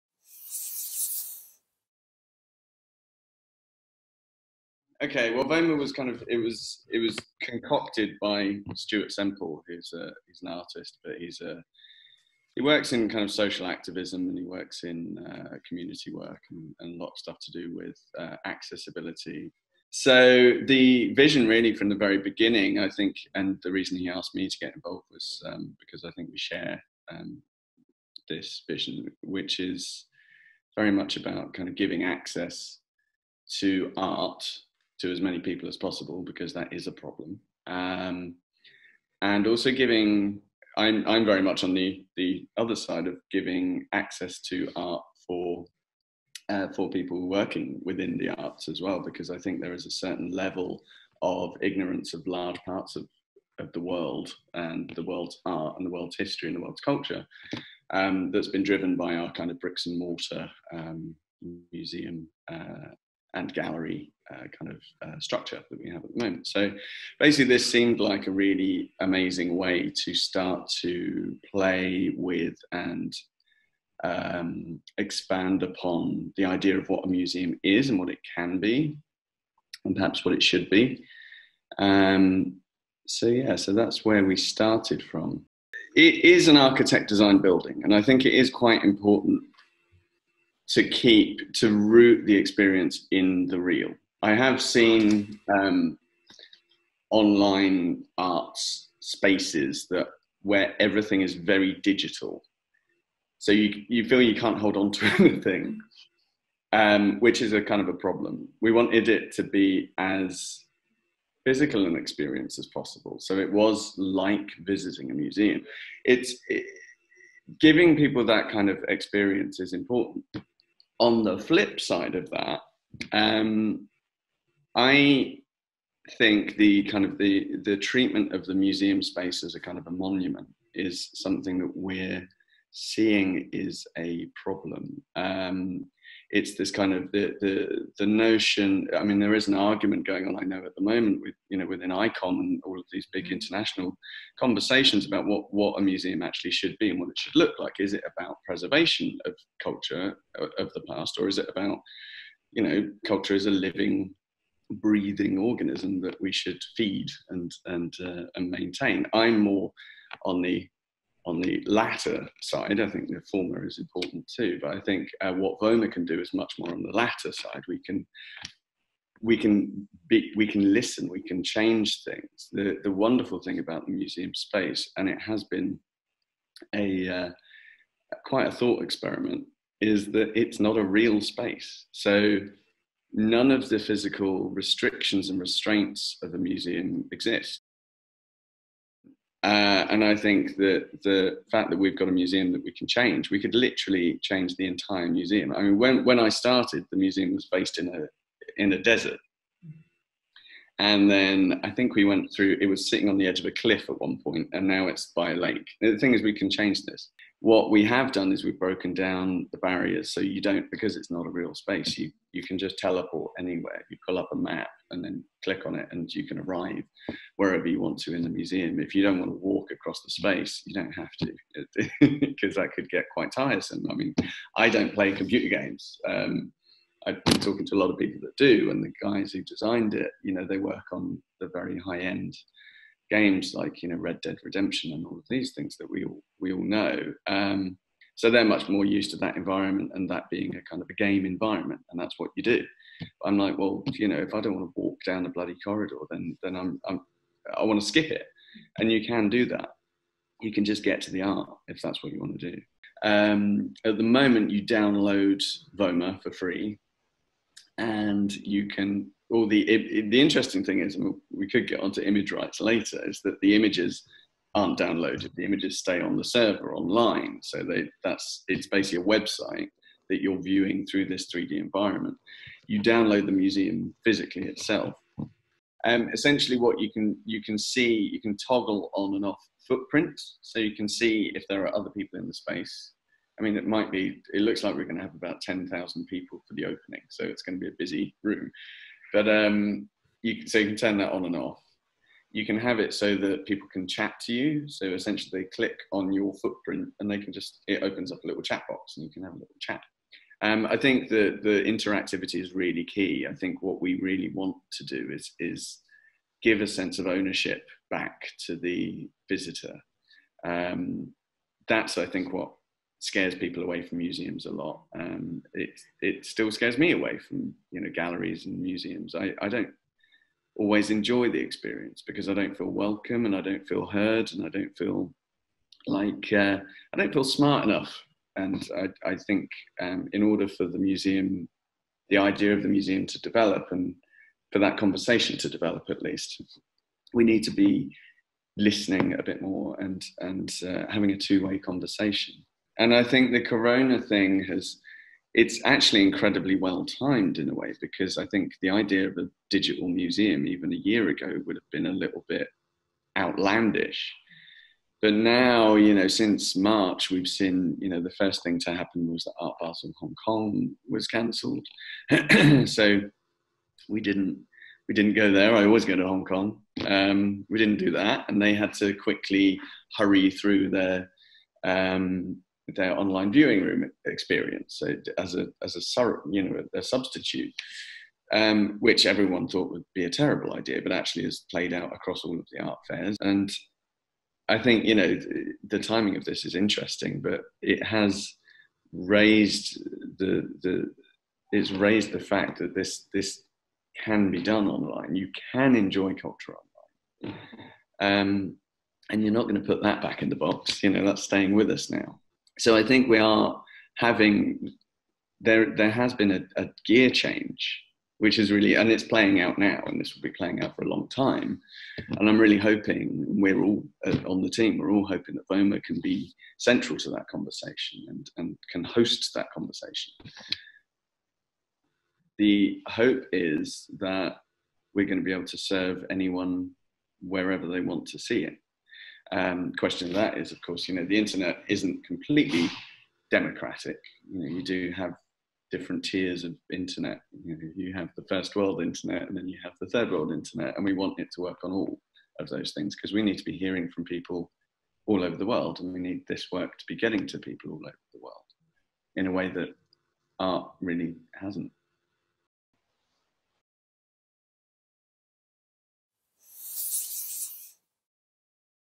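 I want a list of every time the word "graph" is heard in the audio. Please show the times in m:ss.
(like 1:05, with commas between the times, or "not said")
not said.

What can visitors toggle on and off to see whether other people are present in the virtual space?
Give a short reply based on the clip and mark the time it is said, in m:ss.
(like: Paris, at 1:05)
Footprints, at 4:39.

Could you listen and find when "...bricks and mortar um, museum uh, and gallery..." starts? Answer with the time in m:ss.
0:59.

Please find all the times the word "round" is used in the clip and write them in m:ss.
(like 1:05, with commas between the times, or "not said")
not said.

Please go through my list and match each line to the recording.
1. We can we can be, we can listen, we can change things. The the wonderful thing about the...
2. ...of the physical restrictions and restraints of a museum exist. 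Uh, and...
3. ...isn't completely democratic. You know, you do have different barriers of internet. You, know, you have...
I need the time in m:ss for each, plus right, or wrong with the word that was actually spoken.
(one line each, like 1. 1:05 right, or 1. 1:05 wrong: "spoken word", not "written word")
1. 2:47 right
2. 3:03 right
3. 7:11 wrong: "tiers", not "barriers".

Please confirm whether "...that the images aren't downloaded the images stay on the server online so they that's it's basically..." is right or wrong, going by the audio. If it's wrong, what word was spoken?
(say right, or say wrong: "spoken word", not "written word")
right.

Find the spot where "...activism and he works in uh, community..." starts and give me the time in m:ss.
0:13.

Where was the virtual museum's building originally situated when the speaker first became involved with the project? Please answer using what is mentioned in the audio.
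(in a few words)
In a desert.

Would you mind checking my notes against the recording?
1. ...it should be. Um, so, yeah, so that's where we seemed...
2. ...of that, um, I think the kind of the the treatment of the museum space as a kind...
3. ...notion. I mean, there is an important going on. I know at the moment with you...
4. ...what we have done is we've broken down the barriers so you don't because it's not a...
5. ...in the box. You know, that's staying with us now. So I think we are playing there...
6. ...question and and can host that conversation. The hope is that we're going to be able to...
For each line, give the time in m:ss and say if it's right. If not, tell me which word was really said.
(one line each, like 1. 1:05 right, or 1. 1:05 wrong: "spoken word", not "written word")
1. 1:20 wrong: "started", not "seemed"
2. 2:02 right
3. 2:18 wrong: "argument", not "important"
4. 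3:27 right
5. 6:40 wrong: "having", not "playing"
6. 6:57 wrong: "conversation", not "question".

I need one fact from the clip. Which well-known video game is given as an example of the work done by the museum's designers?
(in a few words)
Red Dead Redemption.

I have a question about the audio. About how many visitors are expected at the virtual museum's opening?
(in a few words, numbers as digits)
10,000.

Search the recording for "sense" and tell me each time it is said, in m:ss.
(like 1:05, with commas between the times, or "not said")
5:06.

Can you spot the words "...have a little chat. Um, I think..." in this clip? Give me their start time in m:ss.
4:59.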